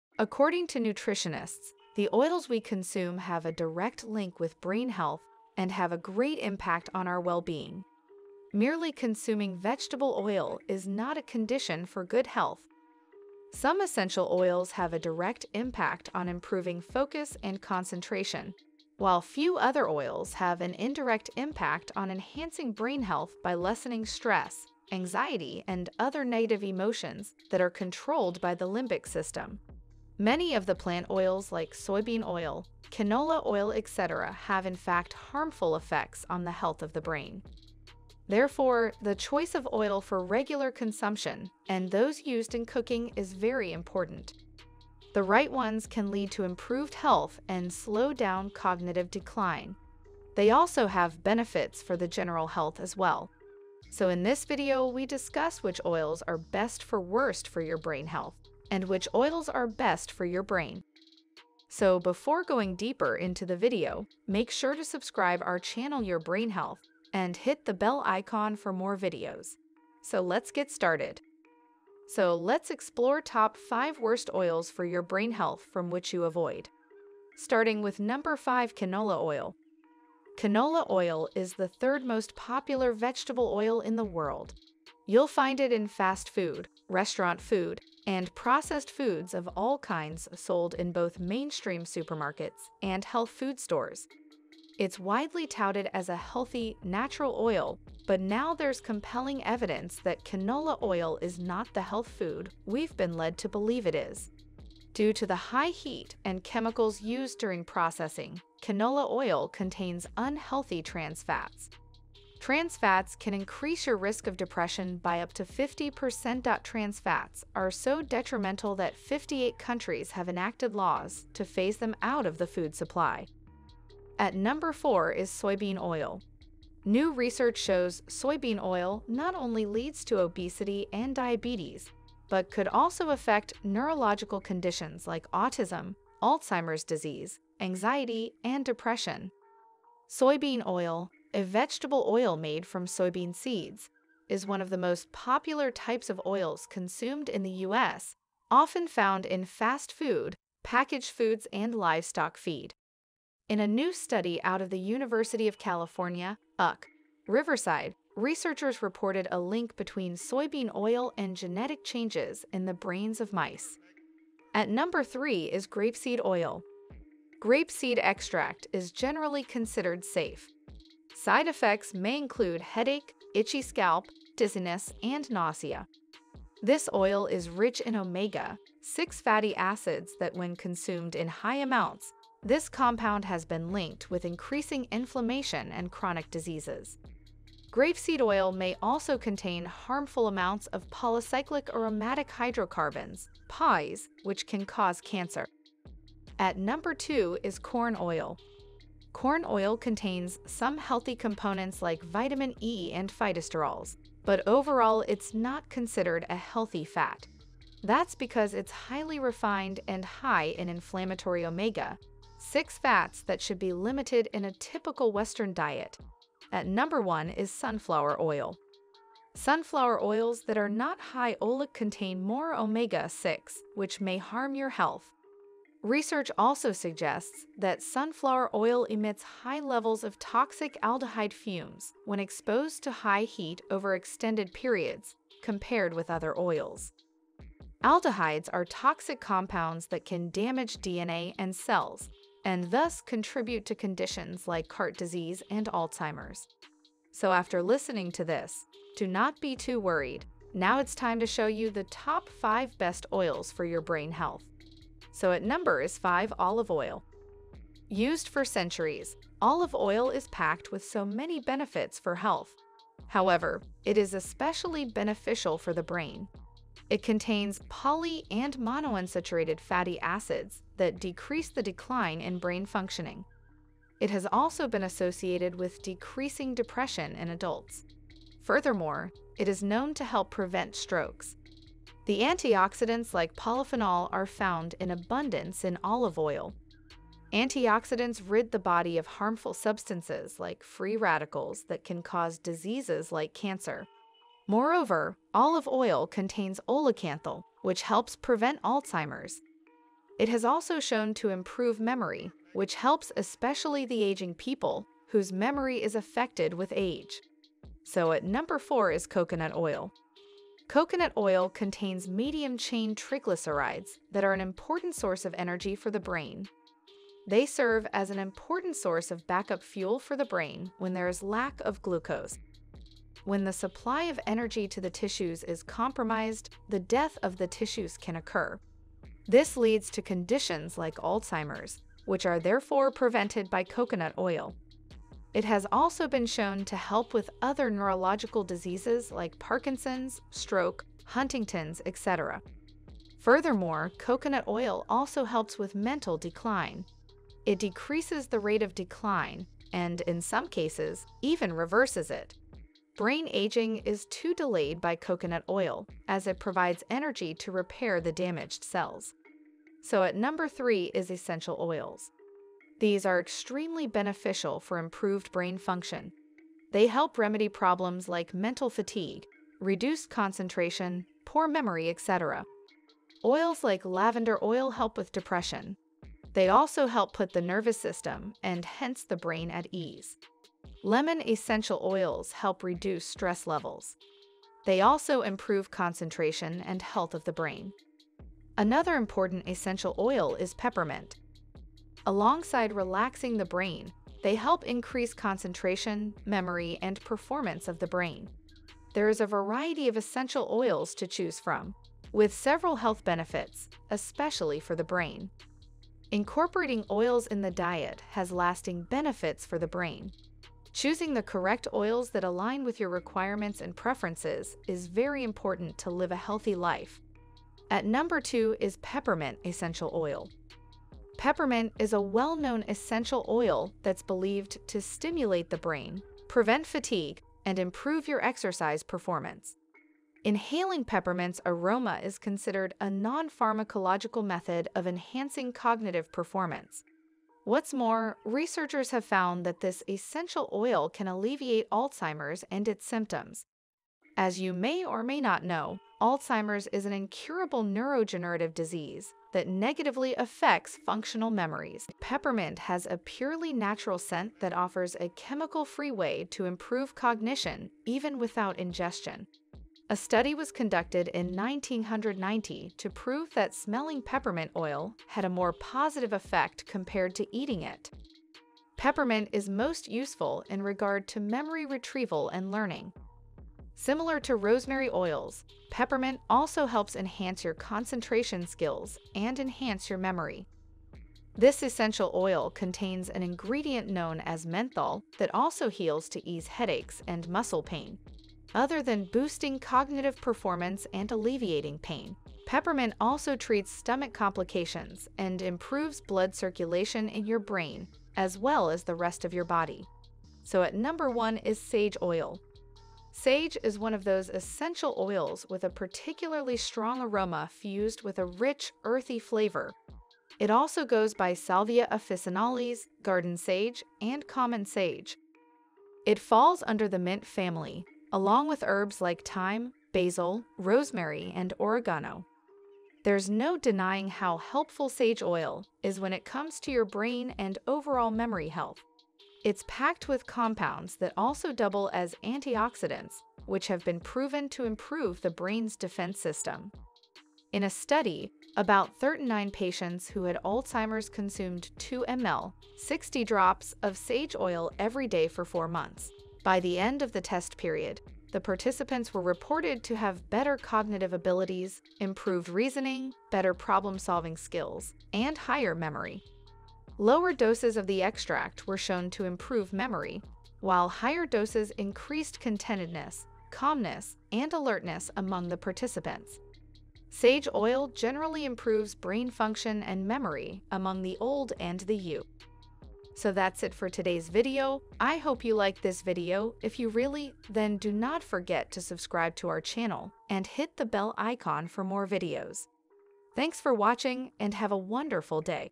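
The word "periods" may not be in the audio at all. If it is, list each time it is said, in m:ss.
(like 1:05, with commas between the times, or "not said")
3:54, 9:07.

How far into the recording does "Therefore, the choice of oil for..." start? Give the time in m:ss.
0:38.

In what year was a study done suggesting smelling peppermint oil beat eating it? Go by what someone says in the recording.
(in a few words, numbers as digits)
1990.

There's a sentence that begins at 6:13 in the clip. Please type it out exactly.
Oils like lavender oil help with depression.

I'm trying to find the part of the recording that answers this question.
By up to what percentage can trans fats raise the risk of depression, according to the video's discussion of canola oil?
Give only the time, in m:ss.
1:55.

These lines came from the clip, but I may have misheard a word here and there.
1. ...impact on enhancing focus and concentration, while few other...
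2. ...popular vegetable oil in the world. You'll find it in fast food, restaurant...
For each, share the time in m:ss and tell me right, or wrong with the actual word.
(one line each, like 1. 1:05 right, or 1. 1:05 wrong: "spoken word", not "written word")
1. 0:15 wrong: "improving", not "enhancing"
2. 1:22 right.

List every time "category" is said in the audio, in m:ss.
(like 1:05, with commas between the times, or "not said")
not said.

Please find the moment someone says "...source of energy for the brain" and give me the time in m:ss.
5:14.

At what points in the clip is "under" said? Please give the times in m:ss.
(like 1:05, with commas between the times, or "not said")
8:36.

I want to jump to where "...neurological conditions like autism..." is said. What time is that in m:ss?
2:13.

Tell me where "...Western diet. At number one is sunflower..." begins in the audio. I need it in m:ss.
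3:35.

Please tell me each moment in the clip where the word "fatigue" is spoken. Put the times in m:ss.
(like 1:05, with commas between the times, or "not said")
6:08, 7:06.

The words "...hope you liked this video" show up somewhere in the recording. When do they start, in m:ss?
9:35.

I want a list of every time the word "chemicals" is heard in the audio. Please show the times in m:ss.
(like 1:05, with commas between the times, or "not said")
1:46, 7:35.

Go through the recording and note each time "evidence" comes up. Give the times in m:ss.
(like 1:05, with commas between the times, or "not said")
1:39.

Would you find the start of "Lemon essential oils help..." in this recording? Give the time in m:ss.
6:20.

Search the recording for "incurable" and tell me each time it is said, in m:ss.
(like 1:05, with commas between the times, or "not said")
7:26.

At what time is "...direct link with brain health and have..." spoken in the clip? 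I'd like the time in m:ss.
0:03.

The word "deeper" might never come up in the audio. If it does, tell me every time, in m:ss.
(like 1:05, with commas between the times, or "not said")
1:02.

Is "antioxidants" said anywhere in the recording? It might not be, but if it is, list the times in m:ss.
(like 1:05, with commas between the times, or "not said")
4:42, 4:47, 8:52.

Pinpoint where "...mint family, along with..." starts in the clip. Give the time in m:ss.
8:36.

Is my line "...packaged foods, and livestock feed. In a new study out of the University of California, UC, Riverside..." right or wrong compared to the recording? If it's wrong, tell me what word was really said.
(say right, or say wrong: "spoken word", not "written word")
right.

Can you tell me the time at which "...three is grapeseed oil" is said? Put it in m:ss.
2:45.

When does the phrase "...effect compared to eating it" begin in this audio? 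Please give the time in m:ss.
7:46.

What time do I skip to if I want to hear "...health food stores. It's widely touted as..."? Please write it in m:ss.
1:33.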